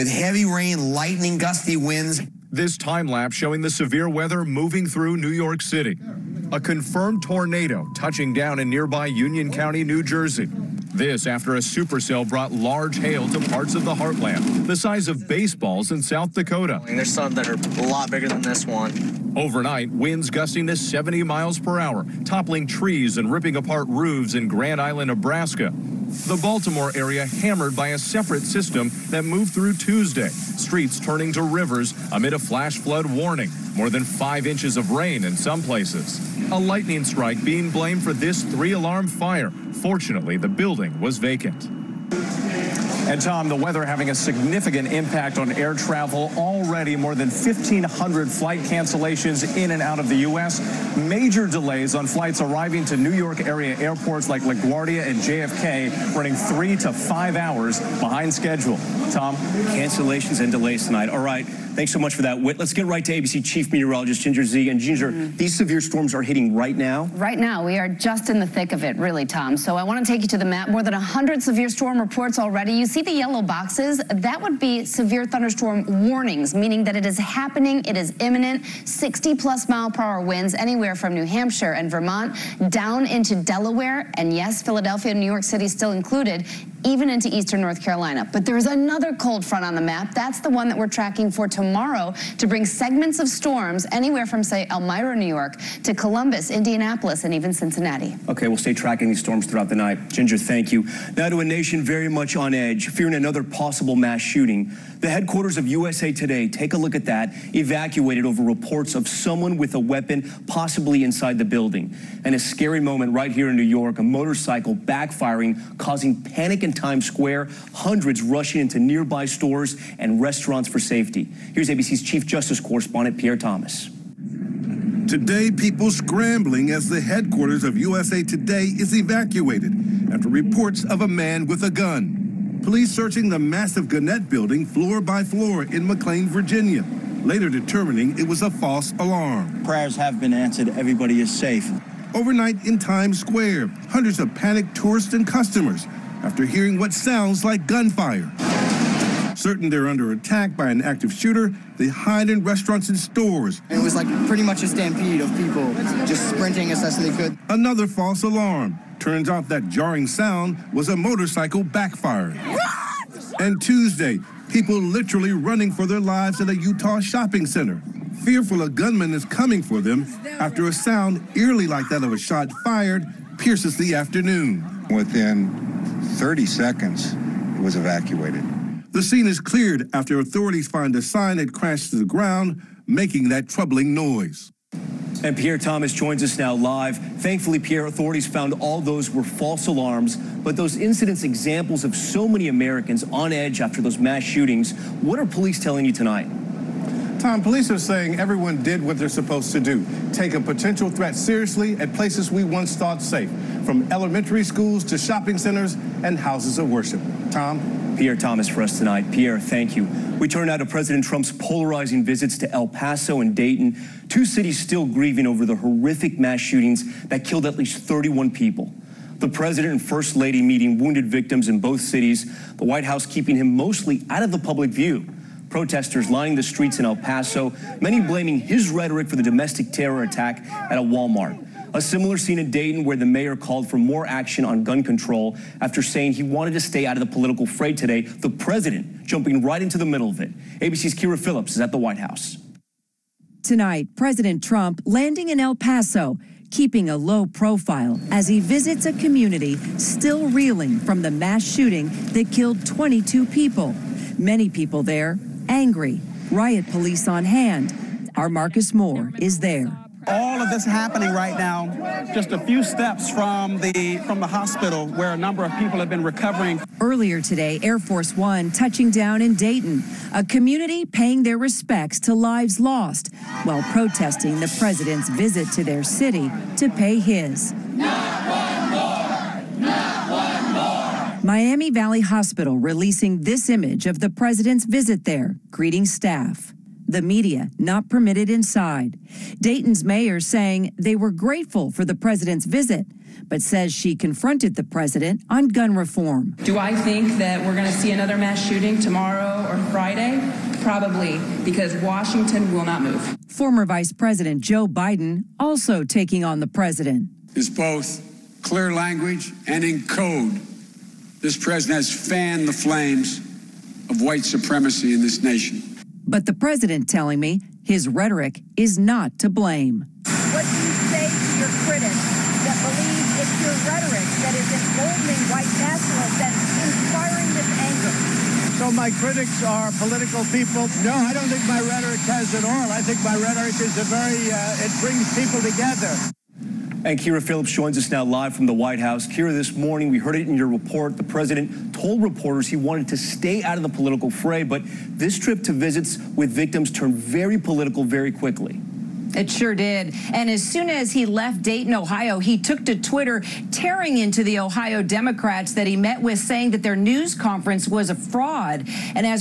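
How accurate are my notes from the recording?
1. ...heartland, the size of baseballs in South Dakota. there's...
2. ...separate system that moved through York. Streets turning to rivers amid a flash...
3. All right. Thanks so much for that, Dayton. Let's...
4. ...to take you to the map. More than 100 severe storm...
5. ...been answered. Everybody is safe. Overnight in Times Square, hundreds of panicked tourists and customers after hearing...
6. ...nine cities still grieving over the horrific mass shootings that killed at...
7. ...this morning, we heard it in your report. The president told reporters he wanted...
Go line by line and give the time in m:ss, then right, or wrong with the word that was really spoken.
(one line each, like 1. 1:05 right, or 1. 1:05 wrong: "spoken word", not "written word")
1. 0:13 right
2. 0:27 wrong: "Tuesday", not "York"
3. 1:01 wrong: "Whit", not "Dayton"
4. 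1:10 right
5. 2:20 right
6. 3:34 wrong: "two", not "nine"
7. 5:39 right.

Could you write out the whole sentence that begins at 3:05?
And Pierre Thomas joins us now live.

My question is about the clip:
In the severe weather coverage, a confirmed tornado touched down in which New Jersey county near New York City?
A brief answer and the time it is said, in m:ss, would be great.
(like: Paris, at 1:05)
Union County, at 0:09.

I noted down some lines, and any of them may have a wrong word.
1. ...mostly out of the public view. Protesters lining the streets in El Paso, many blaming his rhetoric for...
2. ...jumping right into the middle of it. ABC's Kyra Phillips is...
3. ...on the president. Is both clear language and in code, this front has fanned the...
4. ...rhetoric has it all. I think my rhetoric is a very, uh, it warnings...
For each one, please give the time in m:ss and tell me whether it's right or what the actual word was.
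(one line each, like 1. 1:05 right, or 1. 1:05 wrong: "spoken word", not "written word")
1. 3:43 right
2. 3:59 right
3. 5:06 wrong: "president", not "front"
4. 5:31 wrong: "brings", not "warnings".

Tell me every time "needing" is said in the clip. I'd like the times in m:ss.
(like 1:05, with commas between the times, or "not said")
not said.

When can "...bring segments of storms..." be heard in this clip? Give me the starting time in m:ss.
1:32.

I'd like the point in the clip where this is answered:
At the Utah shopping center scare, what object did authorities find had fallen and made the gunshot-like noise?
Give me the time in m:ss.
3:00.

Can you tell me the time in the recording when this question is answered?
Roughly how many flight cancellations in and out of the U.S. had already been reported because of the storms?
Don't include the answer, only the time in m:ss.
0:47.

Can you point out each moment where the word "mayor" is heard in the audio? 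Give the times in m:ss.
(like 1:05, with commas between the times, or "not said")
3:53, 4:49.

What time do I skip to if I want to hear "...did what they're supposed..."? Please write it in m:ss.
3:18.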